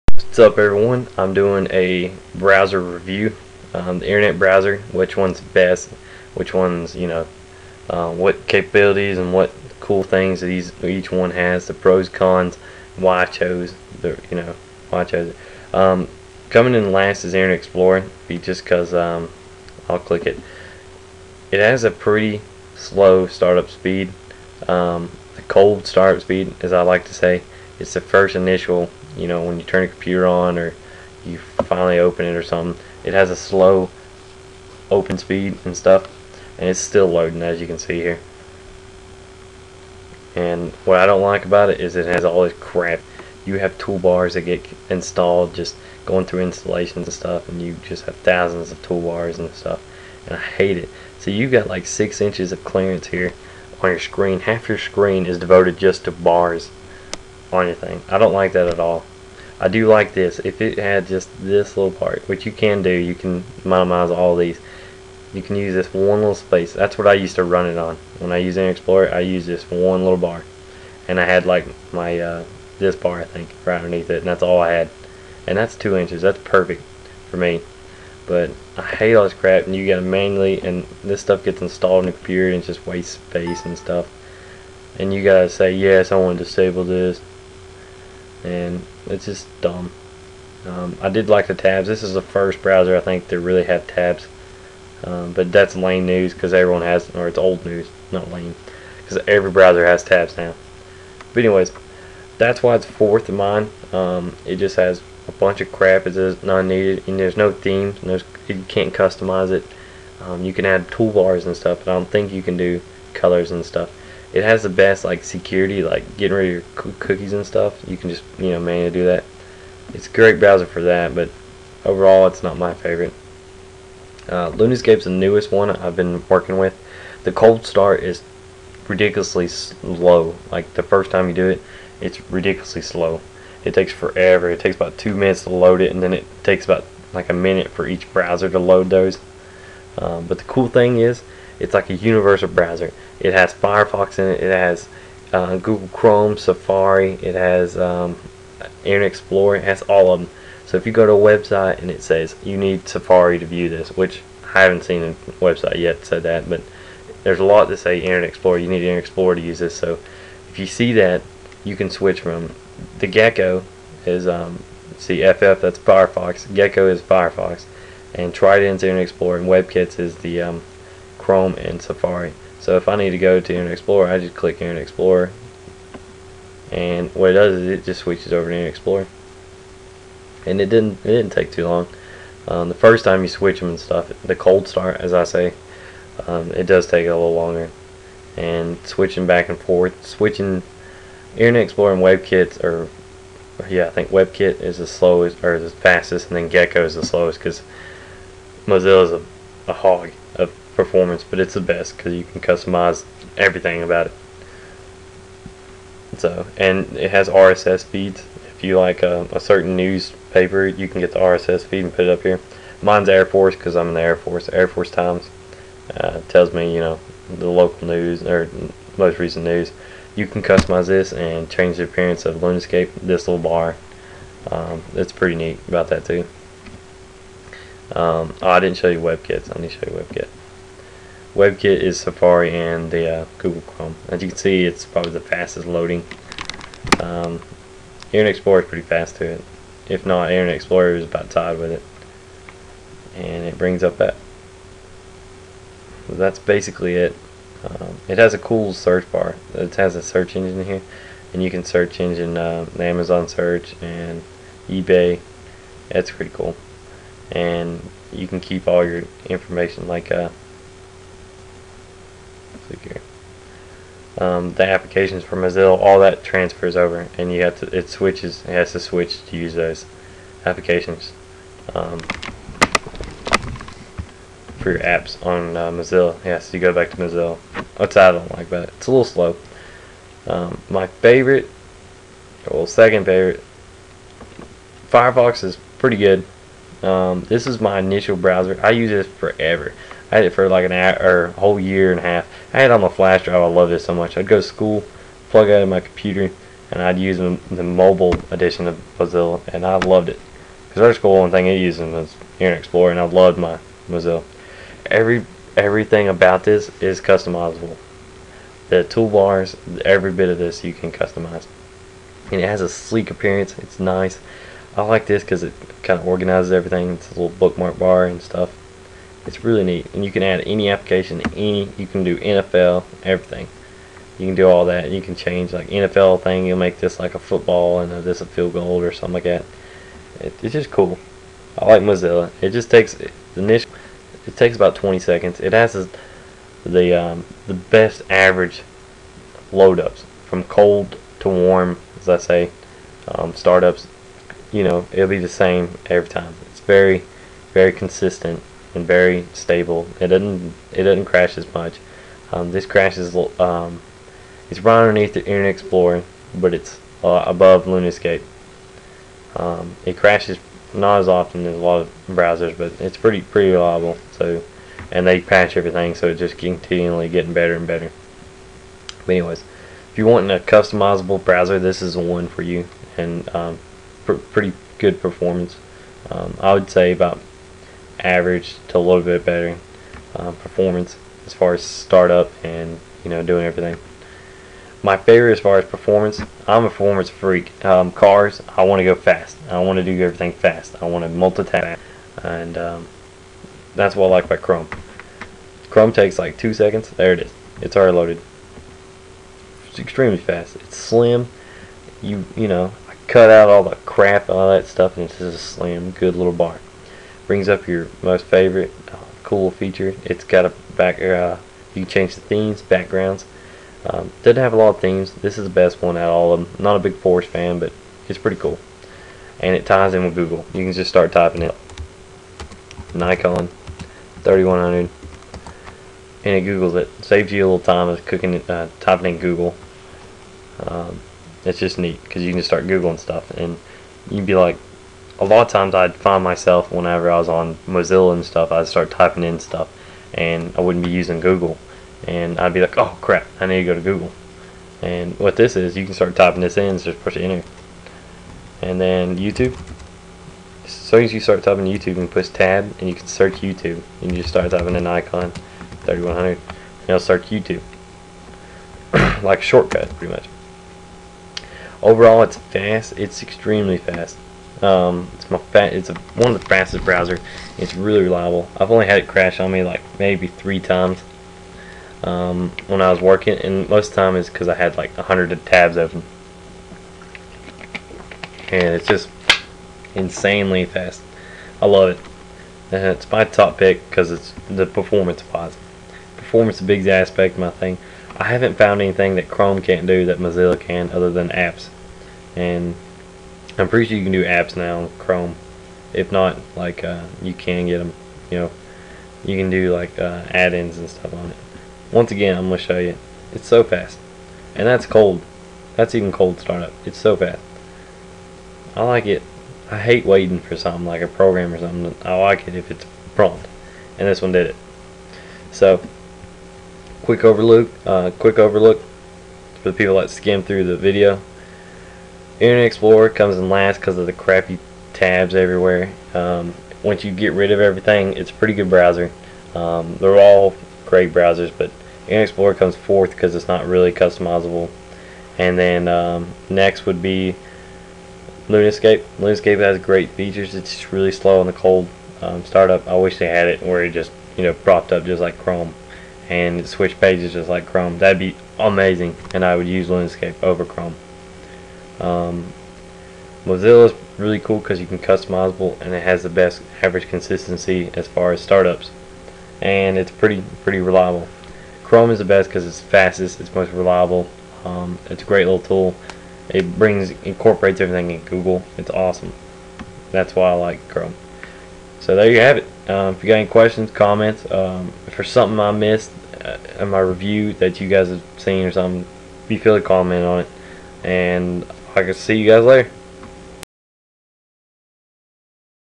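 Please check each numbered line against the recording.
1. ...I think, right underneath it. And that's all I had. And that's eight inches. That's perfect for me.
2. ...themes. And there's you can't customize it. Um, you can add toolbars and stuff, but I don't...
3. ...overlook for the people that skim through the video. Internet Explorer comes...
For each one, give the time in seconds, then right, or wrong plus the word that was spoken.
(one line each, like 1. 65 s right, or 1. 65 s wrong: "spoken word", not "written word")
1. 73 s wrong: "two", not "eight"
2. 107 s right
3. 518 s right.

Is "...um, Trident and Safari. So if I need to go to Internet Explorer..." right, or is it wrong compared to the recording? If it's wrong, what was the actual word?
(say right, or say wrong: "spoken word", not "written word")
wrong: "Chrome", not "Trident".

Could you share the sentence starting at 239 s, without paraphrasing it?
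If not, Internet Explorer is about tied with it.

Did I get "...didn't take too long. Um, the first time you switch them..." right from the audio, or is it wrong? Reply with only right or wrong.
right.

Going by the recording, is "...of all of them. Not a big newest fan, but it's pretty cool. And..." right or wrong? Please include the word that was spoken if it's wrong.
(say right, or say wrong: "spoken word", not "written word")
wrong: "forest", not "newest".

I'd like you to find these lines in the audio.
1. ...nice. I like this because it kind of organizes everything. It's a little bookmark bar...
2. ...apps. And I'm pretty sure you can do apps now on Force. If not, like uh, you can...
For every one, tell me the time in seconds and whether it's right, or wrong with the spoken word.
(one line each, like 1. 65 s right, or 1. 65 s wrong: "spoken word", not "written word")
1. 313 s right
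2. 491 s wrong: "Chrome", not "Force".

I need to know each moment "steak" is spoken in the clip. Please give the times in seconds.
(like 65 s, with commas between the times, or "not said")
not said.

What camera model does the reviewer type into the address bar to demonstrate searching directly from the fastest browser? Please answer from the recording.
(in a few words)
Nikon 3100.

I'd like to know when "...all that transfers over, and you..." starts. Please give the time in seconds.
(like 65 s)
265 s.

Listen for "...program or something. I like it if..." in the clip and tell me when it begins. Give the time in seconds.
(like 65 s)
511 s.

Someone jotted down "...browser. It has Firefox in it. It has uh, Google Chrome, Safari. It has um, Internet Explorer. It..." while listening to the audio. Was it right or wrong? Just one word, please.
right.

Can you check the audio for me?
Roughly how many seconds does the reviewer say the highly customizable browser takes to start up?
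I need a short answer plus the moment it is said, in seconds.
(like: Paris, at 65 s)
20 seconds, at 334 s.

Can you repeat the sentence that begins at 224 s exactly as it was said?
Um, it's pretty neat about that too.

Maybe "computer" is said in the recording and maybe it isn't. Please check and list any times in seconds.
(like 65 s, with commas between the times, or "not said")
29 s, 82 s, 295 s.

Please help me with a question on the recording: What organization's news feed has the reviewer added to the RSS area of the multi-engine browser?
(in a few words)
Air Force Times.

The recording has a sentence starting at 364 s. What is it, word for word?
So, and they patch everything, so it's just continually getting better and better.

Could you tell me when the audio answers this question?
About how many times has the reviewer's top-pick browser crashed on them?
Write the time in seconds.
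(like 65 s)
470 s.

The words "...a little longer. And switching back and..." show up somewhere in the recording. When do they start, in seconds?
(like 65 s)
187 s.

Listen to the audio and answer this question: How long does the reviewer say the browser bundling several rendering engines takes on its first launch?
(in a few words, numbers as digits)
2 minutes.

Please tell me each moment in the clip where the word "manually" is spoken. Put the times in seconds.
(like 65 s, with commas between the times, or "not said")
80 s, 118 s.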